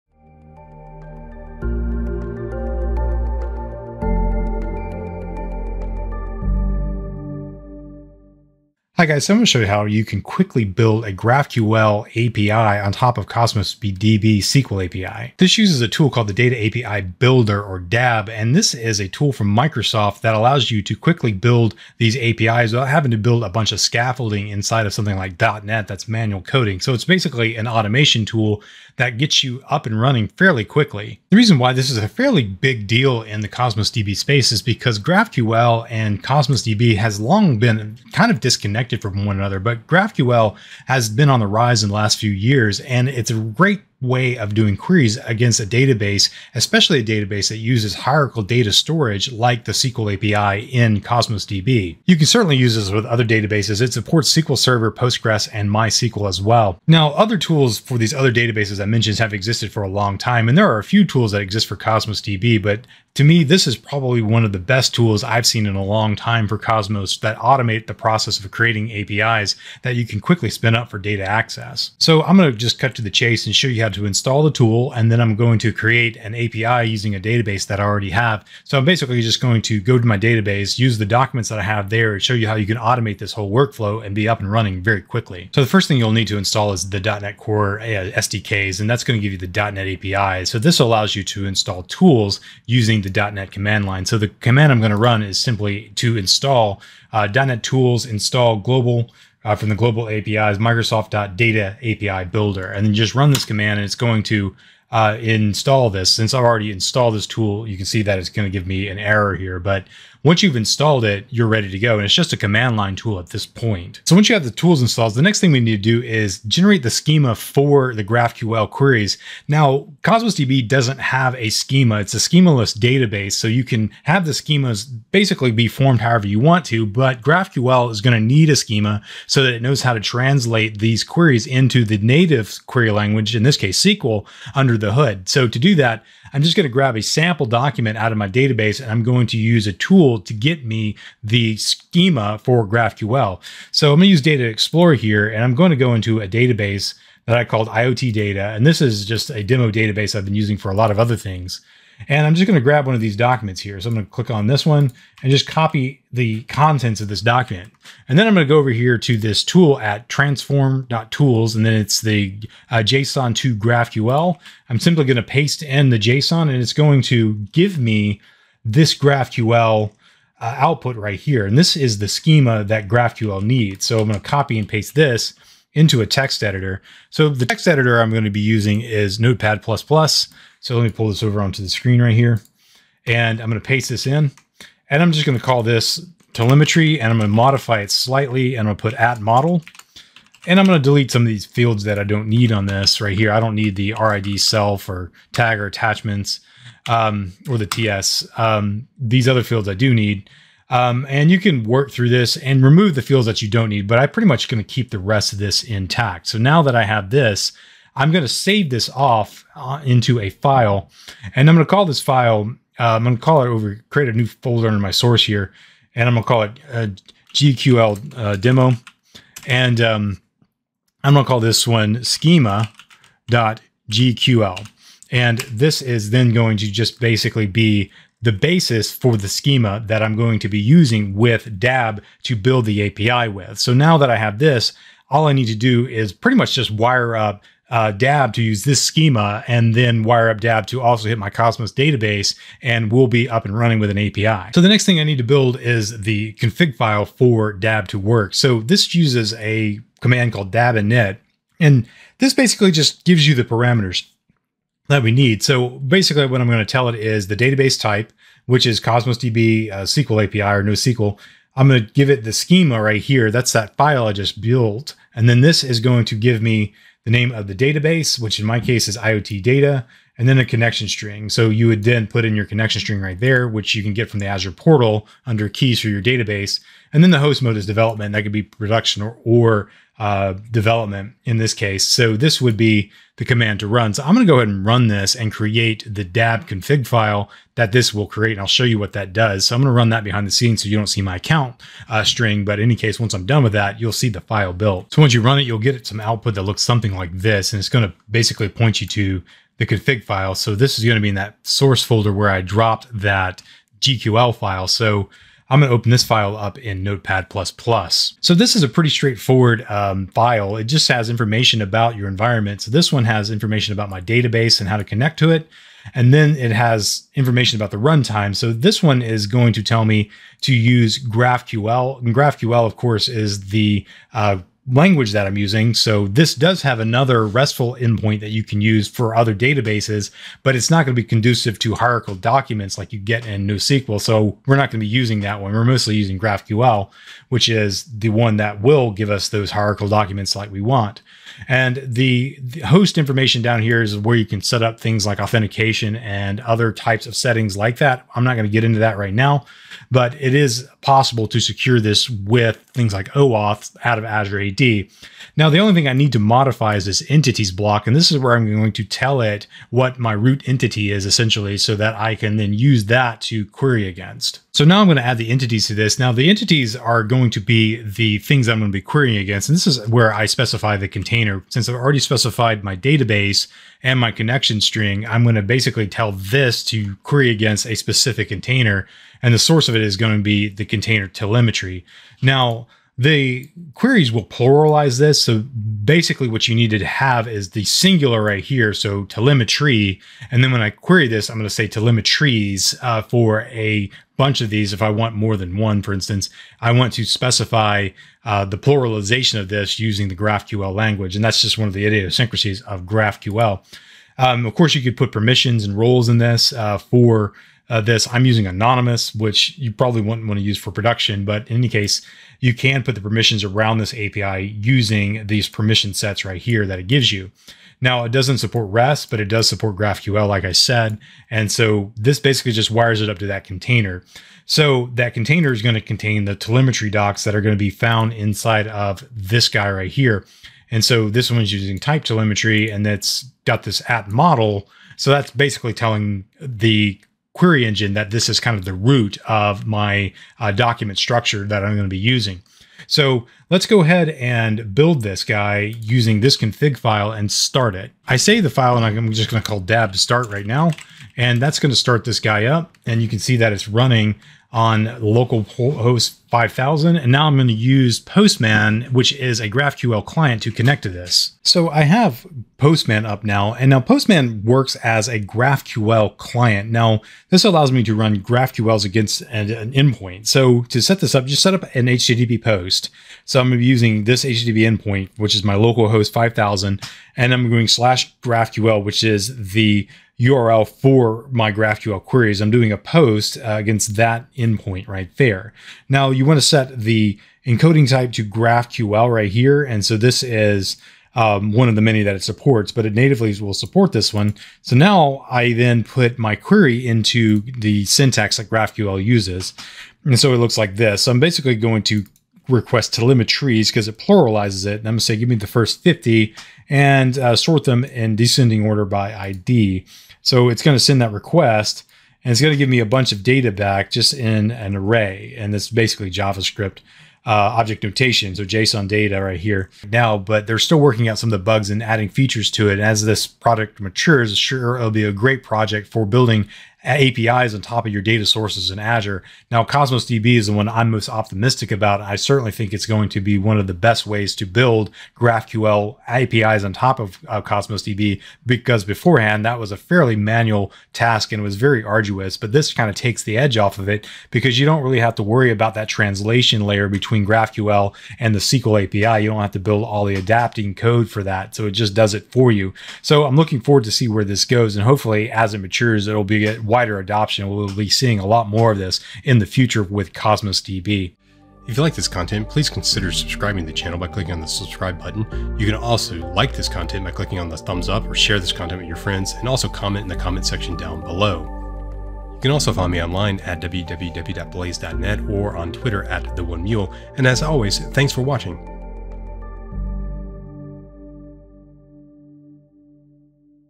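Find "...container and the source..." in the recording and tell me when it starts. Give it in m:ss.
6:18.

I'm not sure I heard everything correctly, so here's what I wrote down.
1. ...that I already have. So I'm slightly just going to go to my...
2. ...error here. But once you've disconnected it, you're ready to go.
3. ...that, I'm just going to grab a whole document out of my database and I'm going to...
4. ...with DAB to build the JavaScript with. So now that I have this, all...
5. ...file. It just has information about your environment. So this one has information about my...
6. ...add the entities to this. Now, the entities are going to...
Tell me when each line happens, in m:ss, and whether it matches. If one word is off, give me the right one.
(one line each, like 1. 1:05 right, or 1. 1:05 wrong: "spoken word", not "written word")
1. 1:17 wrong: "basically", not "slightly"
2. 1:48 wrong: "installed", not "disconnected"
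3. 2:15 wrong: "sample", not "whole"
4. 3:51 wrong: "API", not "JavaScript"
5. 5:10 right
6. 6:05 right.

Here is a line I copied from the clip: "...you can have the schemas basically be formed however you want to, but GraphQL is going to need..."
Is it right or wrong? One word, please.
right.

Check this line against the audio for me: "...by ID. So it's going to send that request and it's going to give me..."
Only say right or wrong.
right.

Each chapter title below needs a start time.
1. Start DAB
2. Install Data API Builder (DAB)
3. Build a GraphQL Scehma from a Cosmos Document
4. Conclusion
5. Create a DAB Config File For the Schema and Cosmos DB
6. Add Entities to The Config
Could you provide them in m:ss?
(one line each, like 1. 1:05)
1. 7:27
2. 1:25
3. 1:52
4. 8:51
5. 4:03
6. 6:04.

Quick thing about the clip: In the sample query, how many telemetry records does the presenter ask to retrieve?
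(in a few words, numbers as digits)
50.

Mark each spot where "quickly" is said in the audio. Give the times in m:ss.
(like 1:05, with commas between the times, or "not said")
0:10, 0:20, 0:30, 1:10, 1:25.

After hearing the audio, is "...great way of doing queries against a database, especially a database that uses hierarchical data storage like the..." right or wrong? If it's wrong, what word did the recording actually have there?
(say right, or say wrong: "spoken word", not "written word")
right.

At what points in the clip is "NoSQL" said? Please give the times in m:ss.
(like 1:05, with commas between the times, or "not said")
4:20, 5:33.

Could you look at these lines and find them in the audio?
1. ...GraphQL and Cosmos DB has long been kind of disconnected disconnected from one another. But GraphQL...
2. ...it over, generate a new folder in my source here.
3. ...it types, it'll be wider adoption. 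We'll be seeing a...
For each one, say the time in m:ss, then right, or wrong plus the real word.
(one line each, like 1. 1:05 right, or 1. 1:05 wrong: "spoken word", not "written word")
1. 0:34 right
2. 3:33 wrong: "create", not "generate"
3. 9:15 wrong: "matures", not "types".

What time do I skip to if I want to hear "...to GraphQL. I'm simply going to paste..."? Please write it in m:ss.
2:43.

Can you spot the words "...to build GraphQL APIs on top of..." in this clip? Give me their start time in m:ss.
8:54.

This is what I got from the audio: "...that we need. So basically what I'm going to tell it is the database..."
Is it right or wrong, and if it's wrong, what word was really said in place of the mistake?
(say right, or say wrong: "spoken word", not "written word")
right.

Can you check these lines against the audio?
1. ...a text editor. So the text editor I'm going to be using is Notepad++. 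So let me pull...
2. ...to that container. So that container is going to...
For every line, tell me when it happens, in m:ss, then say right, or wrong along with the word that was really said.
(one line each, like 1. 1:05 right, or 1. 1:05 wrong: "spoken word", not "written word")
1. 2:56 right
2. 7:03 right.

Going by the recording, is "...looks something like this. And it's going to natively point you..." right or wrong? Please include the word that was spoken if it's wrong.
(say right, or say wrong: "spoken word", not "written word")
wrong: "basically", not "natively".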